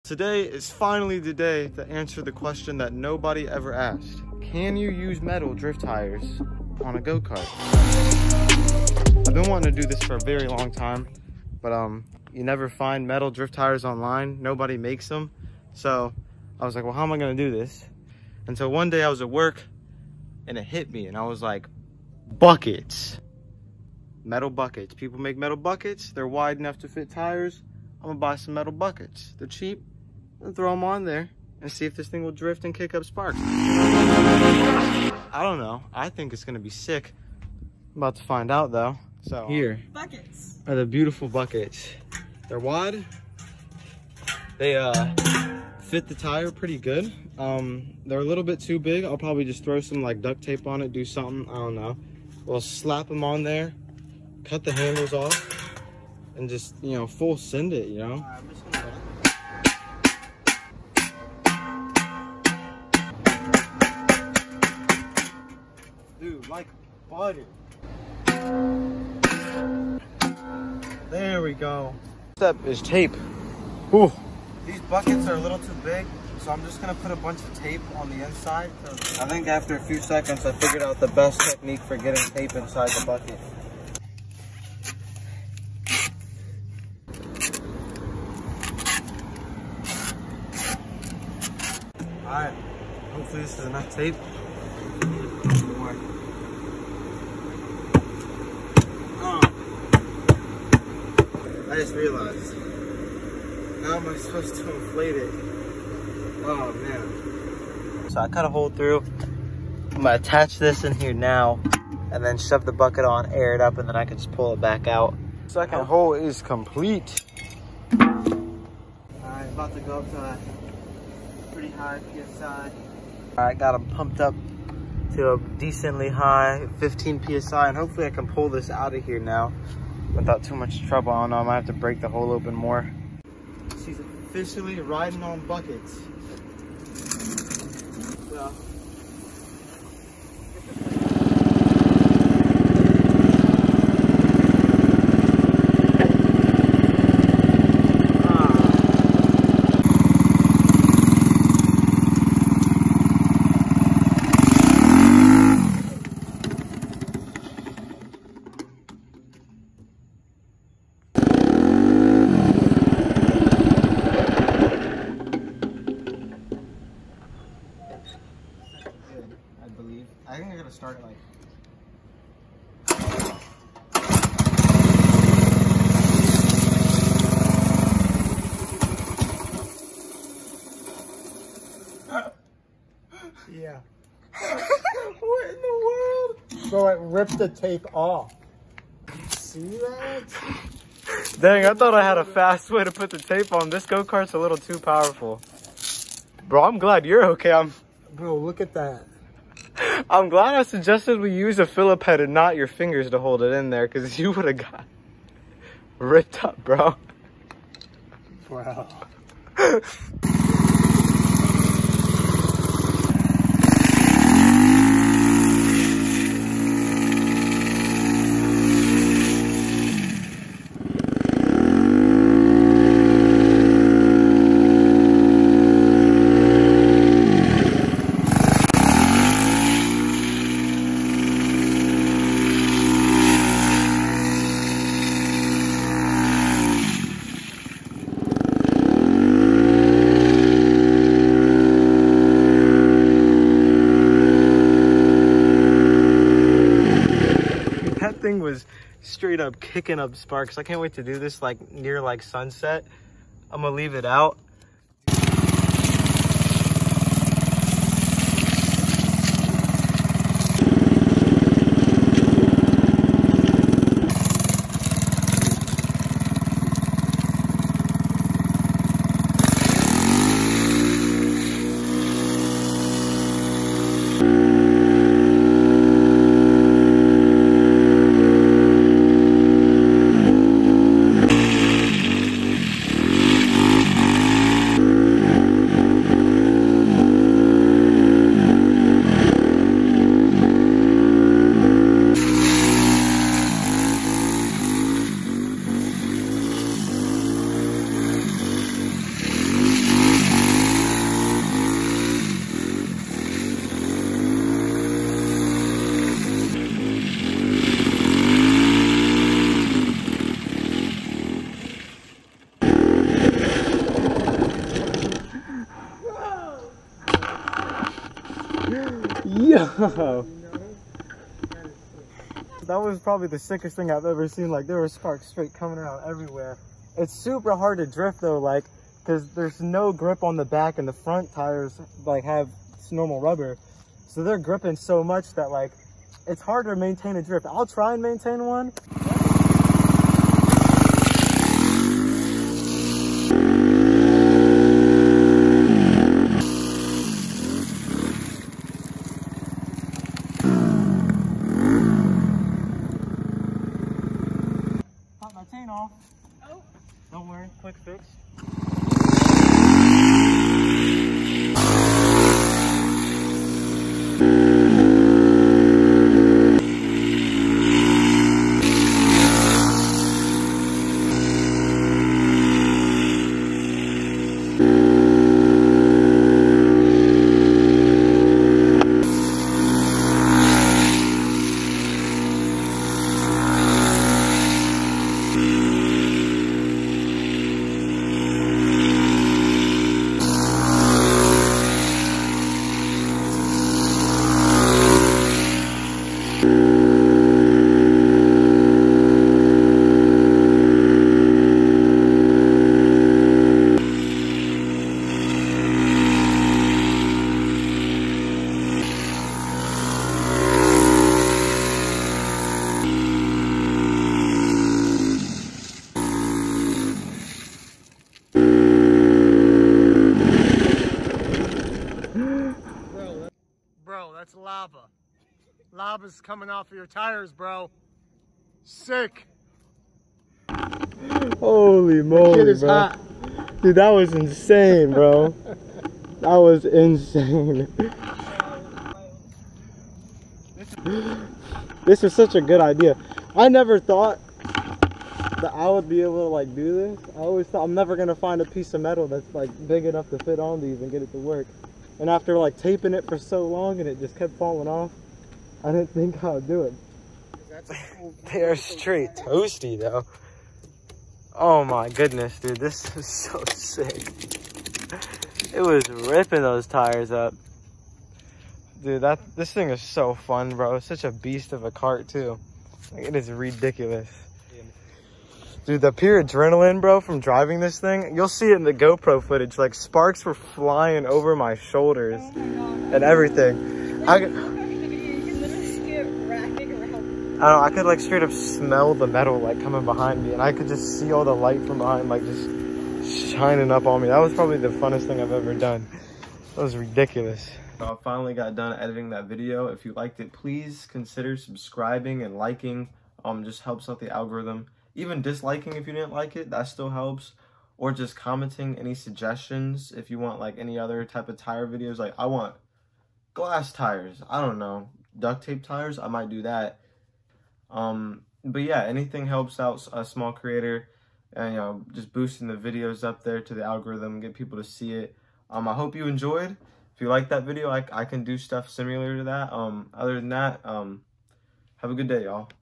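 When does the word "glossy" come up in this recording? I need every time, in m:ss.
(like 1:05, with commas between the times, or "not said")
not said.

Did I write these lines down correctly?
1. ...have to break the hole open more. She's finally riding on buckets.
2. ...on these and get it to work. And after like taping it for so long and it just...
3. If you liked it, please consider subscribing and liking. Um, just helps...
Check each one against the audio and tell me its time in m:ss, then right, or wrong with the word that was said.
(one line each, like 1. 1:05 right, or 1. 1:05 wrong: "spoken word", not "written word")
1. 2:11 wrong: "officially", not "finally"
2. 7:30 right
3. 8:19 right.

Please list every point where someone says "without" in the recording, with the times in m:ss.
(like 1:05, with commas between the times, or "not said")
2:10.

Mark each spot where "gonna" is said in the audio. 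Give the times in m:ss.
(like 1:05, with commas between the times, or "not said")
0:17, 0:28, 0:36, 1:16, 1:50, 4:13, 7:27.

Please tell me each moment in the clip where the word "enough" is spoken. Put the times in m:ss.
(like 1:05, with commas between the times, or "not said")
0:26, 1:33, 7:29.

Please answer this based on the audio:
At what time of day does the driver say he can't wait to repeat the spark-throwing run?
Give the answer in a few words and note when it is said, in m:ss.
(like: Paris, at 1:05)
Sunset, at 4:12.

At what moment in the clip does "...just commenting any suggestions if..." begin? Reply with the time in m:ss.
8:27.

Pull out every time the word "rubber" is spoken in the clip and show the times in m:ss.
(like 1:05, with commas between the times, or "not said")
5:33.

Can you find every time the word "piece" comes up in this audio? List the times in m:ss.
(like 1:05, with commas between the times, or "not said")
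7:28.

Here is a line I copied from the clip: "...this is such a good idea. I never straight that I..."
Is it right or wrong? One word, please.
wrong.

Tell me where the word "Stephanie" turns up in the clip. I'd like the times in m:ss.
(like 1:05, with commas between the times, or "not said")
not said.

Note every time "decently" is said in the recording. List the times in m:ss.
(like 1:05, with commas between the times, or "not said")
2:05.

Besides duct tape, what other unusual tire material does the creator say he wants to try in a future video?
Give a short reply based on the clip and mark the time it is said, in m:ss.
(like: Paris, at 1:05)
Glass, at 8:33.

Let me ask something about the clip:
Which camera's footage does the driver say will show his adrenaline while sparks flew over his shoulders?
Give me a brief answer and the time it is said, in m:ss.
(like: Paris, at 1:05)
GoPro, at 7:58.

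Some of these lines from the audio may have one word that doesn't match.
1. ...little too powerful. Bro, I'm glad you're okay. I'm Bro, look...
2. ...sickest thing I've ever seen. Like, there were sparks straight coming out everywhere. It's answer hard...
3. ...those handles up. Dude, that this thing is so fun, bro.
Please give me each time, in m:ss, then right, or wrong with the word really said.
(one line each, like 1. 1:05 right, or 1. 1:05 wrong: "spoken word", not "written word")
1. 3:14 right
2. 5:23 wrong: "super", not "answer"
3. 7:46 wrong: "tires", not "handles".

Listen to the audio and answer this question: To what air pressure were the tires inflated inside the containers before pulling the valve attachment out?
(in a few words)
15 PSI.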